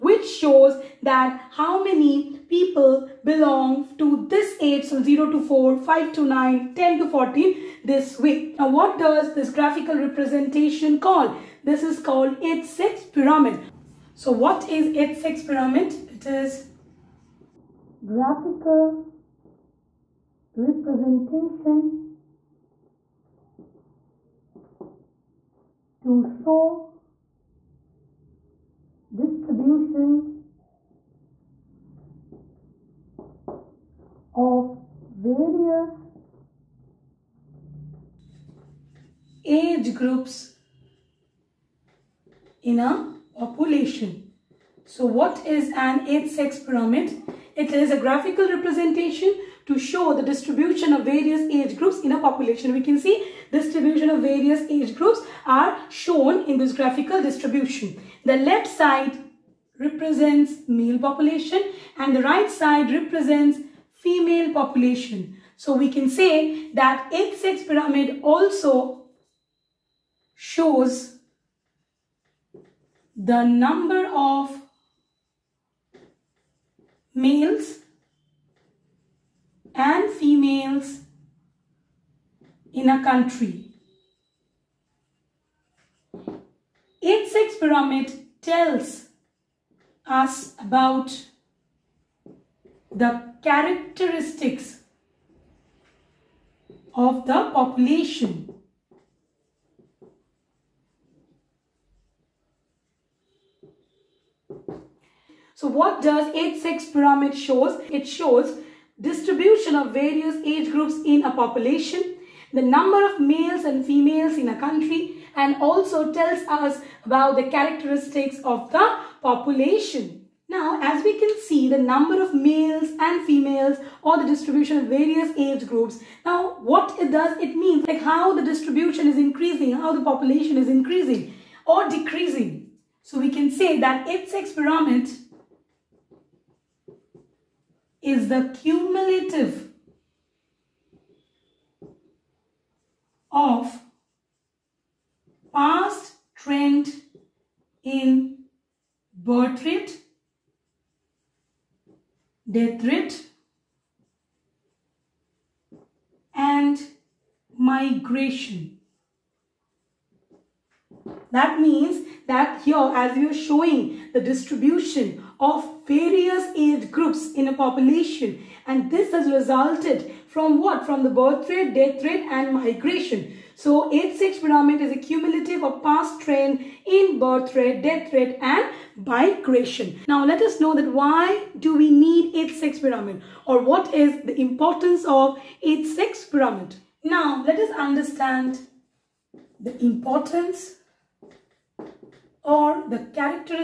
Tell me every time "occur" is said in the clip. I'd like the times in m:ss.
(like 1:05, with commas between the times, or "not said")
not said.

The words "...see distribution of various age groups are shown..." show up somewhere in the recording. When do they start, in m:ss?
0:52.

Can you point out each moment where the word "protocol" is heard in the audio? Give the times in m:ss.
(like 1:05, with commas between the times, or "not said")
not said.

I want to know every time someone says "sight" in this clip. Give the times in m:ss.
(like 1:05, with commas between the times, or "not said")
not said.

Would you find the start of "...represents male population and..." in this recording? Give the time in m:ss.
0:59.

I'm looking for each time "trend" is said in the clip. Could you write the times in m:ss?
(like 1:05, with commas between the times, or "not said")
2:26, 2:56.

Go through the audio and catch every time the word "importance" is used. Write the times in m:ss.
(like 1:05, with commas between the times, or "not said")
3:04, 3:09.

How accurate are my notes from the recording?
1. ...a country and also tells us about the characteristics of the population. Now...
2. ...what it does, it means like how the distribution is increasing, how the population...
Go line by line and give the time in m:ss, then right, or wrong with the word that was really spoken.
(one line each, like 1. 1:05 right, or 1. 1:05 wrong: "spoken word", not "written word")
1. 1:54 right
2. 2:06 right.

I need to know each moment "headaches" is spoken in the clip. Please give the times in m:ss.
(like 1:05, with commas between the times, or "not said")
not said.